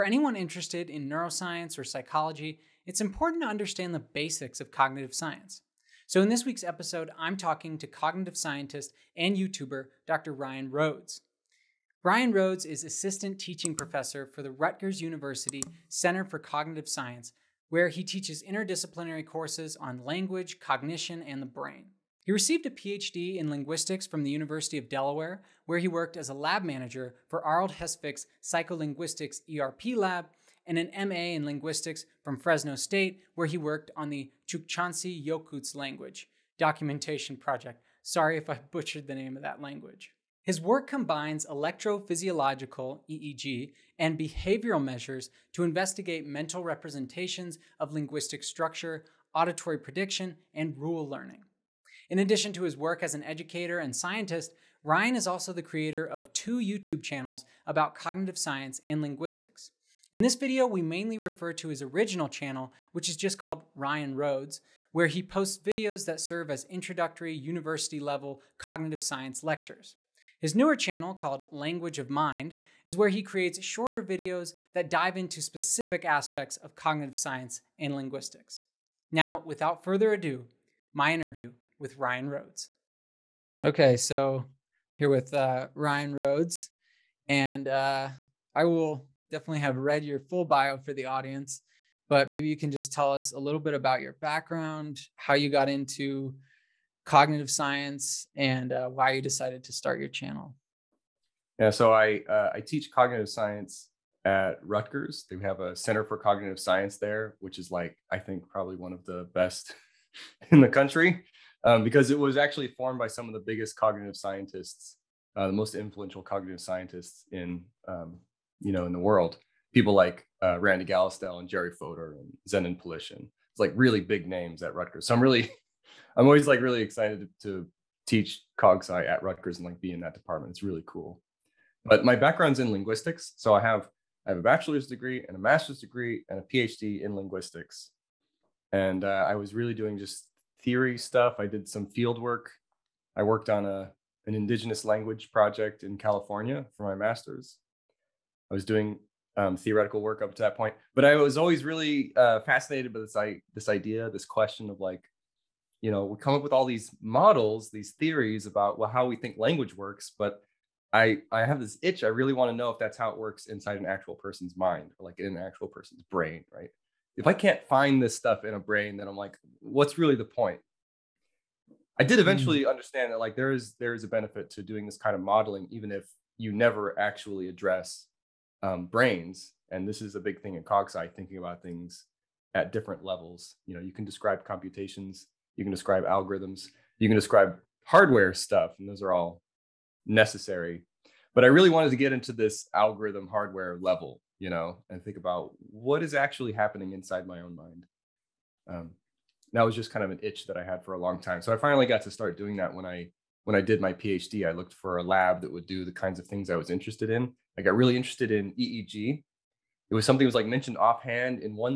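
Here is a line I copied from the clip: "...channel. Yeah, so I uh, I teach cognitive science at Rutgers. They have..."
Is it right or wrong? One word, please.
right.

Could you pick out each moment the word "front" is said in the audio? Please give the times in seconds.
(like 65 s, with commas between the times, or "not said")
not said.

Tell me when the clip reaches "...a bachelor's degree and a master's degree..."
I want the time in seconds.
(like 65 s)
134 s.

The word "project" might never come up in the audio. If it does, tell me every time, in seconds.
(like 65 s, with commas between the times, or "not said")
37 s, 145 s.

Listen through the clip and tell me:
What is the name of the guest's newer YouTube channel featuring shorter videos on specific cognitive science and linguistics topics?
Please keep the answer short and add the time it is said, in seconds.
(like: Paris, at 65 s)
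Language of Mind, at 71 s.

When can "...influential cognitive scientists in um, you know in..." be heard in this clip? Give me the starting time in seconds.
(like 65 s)
115 s.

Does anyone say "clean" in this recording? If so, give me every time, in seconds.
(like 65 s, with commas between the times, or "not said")
not said.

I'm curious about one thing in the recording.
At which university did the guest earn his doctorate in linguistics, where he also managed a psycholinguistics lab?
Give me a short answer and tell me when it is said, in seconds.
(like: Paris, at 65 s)
University of Delaware, at 24 s.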